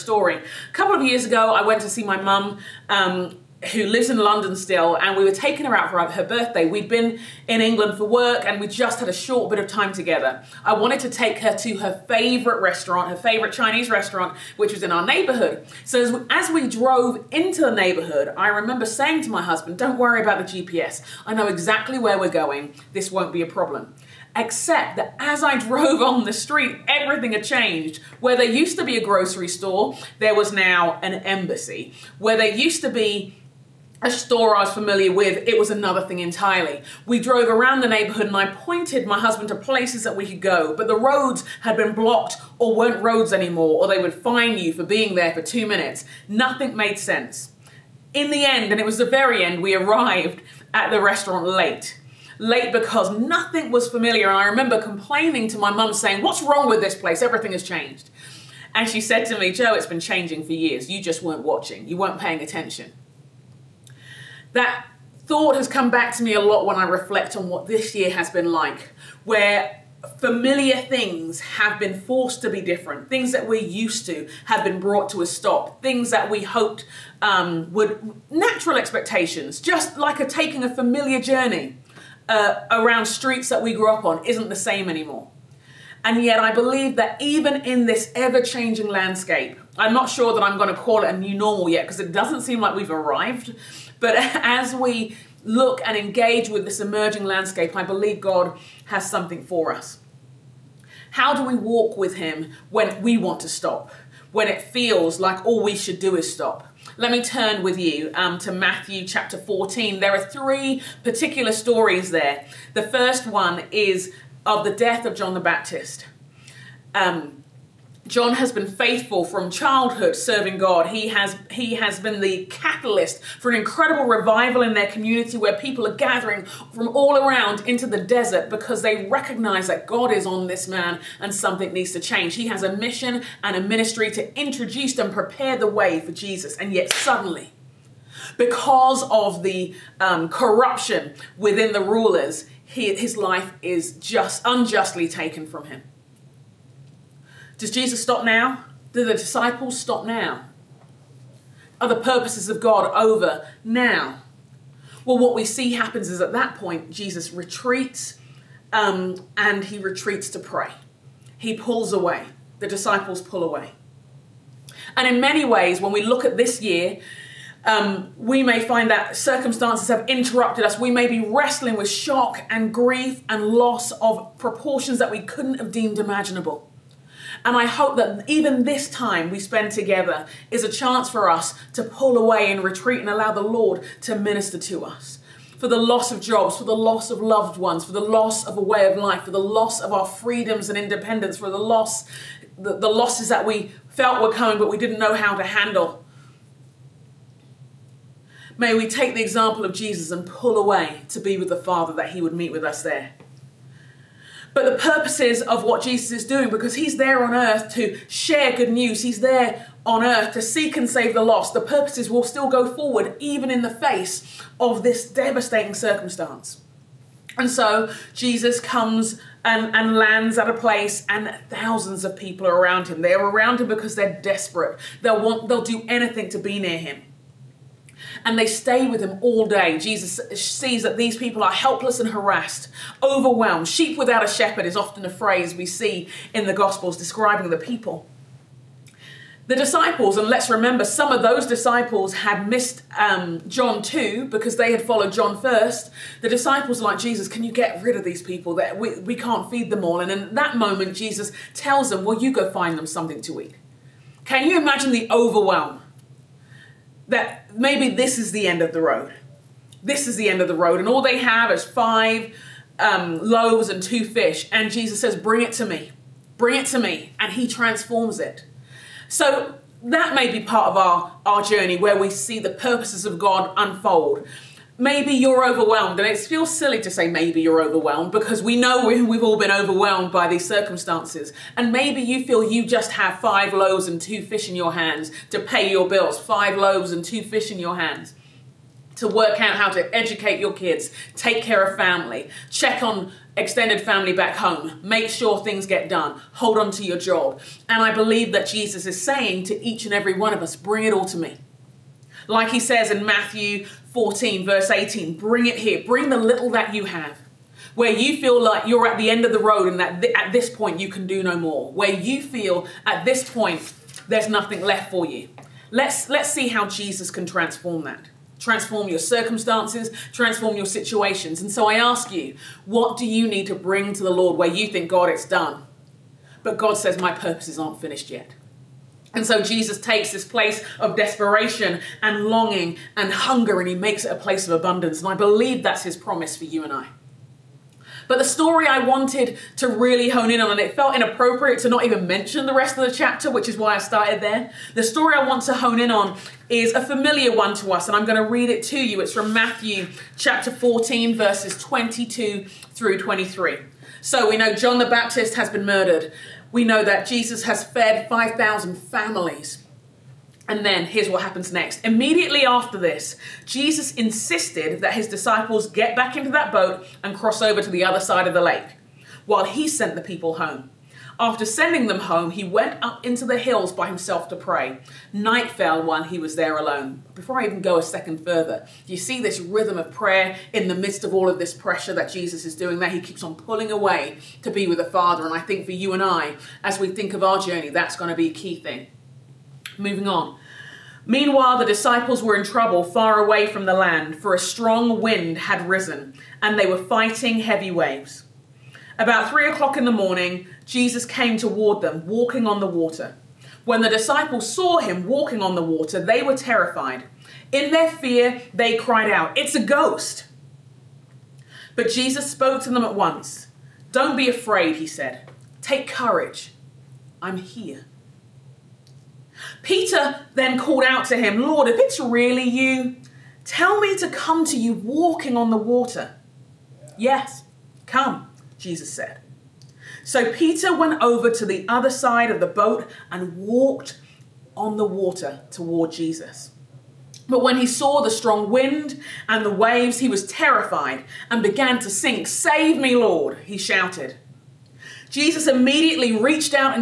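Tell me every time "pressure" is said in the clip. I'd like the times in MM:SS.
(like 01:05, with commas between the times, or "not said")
06:21.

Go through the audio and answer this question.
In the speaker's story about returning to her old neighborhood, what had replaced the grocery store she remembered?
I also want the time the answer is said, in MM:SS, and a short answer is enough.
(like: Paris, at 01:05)
an embassy, at 00:30.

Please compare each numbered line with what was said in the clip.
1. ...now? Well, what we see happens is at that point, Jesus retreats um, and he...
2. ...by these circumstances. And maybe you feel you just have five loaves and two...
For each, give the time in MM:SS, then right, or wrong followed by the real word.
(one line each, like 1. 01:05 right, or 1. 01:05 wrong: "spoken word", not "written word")
1. 02:33 right
2. 04:40 right.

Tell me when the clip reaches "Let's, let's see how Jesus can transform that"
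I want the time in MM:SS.
05:15.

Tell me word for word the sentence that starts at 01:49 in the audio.
There are three particular stories there.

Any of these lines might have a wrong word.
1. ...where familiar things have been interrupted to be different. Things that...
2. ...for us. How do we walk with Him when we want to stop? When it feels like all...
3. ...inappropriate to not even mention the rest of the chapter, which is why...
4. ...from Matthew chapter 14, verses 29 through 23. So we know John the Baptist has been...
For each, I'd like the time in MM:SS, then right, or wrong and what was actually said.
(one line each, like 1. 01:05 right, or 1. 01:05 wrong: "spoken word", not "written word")
1. 01:09 wrong: "forced", not "interrupted"
2. 01:39 right
3. 05:40 right
4. 05:49 wrong: "22", not "29".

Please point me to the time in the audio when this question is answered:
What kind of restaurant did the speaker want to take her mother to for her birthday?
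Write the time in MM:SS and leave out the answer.
00:13.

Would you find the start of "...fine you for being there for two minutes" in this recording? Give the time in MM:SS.
00:44.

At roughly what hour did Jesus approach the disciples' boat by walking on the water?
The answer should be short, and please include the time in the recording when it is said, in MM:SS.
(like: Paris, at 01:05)
3 o'clock in the morning, at 06:39.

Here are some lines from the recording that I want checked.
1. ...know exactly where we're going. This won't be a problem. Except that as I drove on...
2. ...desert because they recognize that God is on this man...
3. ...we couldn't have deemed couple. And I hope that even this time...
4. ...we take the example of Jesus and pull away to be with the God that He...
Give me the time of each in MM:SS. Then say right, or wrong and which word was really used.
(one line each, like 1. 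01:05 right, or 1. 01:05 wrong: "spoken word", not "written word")
1. 00:21 right
2. 02:08 right
3. 02:55 wrong: "imaginable", not "couple"
4. 03:18 wrong: "Father", not "God".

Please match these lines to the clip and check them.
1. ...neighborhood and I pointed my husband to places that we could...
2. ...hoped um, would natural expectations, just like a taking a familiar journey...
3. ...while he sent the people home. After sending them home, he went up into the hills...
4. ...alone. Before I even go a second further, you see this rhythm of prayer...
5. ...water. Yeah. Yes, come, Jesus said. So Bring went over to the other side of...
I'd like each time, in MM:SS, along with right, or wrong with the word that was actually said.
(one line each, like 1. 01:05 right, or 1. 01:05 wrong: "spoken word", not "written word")
1. 00:37 right
2. 01:16 right
3. 06:09 right
4. 06:16 right
5. 07:05 wrong: "Peter", not "Bring".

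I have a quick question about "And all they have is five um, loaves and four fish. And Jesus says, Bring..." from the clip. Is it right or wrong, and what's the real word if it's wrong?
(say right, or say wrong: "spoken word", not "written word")
wrong: "two", not "four".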